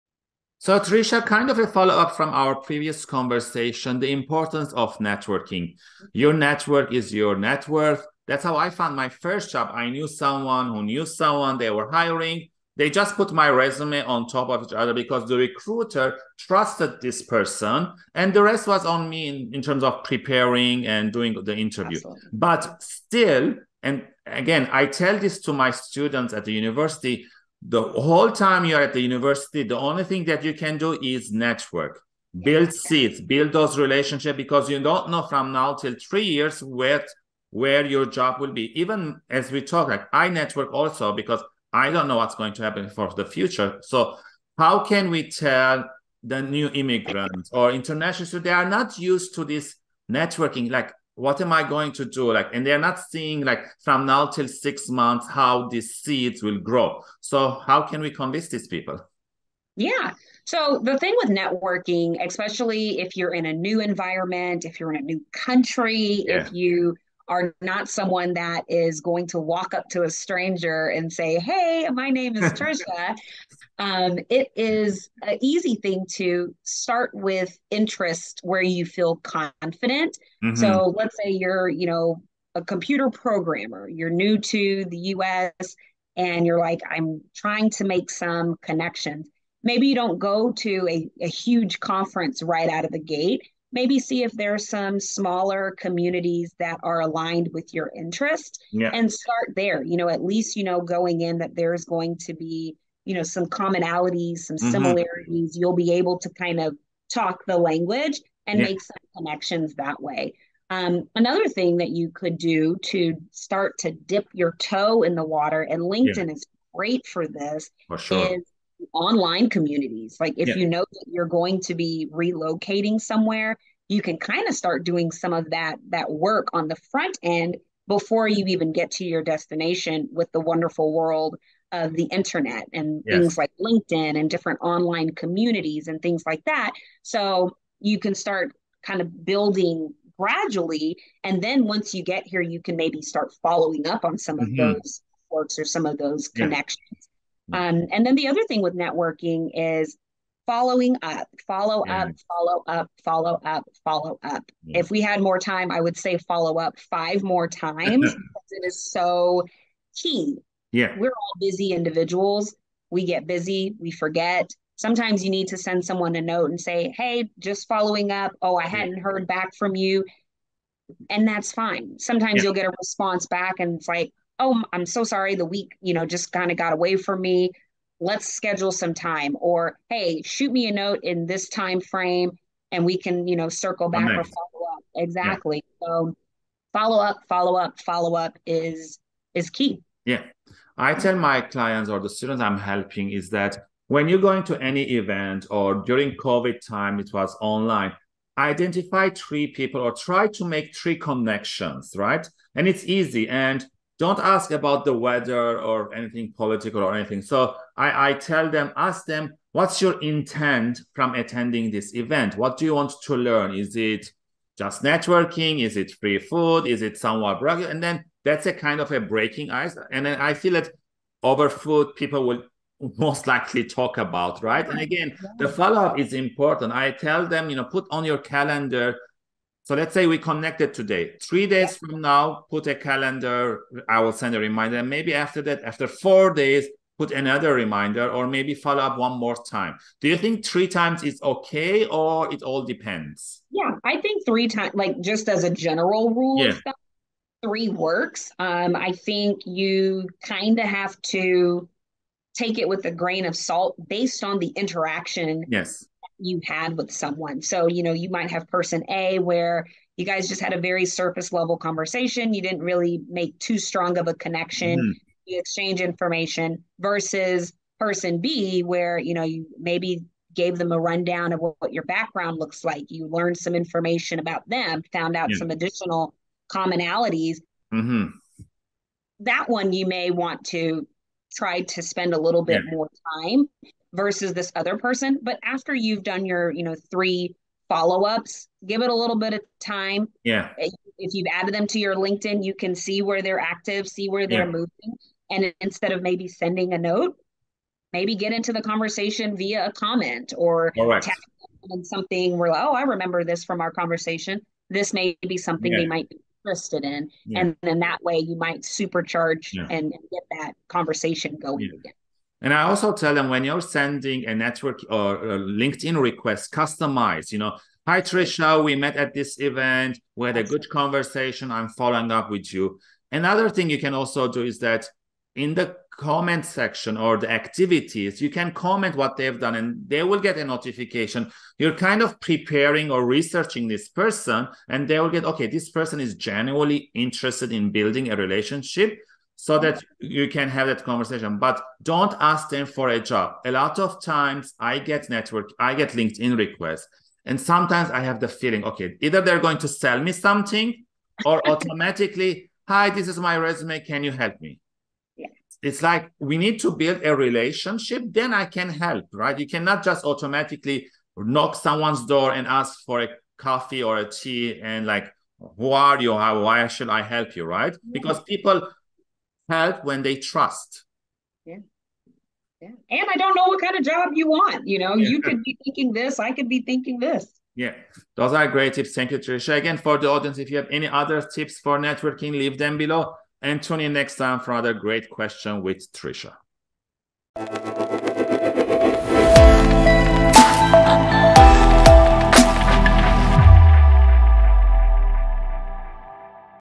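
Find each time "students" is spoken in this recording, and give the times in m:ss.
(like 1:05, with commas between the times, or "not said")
0:25, 3:12.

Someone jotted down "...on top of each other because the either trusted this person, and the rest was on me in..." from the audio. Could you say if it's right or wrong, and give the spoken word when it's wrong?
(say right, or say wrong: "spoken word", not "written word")
wrong: "recruiter", not "either".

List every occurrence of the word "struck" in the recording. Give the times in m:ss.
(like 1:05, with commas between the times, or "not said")
not said.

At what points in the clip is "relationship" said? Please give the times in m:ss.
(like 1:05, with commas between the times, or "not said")
0:33, 5:38, 5:57.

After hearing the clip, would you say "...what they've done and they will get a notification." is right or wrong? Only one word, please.
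right.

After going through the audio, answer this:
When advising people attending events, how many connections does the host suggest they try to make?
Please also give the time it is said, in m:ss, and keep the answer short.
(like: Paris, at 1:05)
3, at 3:19.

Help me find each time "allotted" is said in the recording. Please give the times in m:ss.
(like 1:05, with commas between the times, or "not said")
not said.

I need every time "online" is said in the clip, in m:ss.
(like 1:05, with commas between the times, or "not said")
1:58, 2:14, 3:17.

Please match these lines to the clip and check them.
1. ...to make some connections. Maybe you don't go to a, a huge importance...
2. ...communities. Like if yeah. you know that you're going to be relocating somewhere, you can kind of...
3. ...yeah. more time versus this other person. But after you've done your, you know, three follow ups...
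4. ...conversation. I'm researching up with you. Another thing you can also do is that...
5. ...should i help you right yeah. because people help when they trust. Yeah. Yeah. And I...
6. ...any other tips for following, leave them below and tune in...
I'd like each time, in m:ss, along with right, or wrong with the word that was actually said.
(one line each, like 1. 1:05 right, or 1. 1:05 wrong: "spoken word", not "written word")
1. 1:27 wrong: "conference", not "importance"
2. 1:59 right
3. 4:42 right
4. 5:20 wrong: "following", not "researching"
5. 6:06 right
6. 6:20 wrong: "networking", not "following".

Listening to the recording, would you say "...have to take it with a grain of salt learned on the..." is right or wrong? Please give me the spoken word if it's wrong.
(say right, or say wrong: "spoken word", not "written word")
wrong: "based", not "learned".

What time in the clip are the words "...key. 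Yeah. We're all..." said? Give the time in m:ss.
2:39.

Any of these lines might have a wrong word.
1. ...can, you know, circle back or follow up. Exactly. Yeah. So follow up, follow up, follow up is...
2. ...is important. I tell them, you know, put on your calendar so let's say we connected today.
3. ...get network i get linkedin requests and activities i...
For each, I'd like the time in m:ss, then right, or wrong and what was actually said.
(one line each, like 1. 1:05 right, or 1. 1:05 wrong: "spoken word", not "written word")
1. 3:02 right
2. 3:45 right
3. 5:44 wrong: "sometimes", not "activities".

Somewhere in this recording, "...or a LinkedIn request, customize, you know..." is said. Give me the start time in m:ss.
5:14.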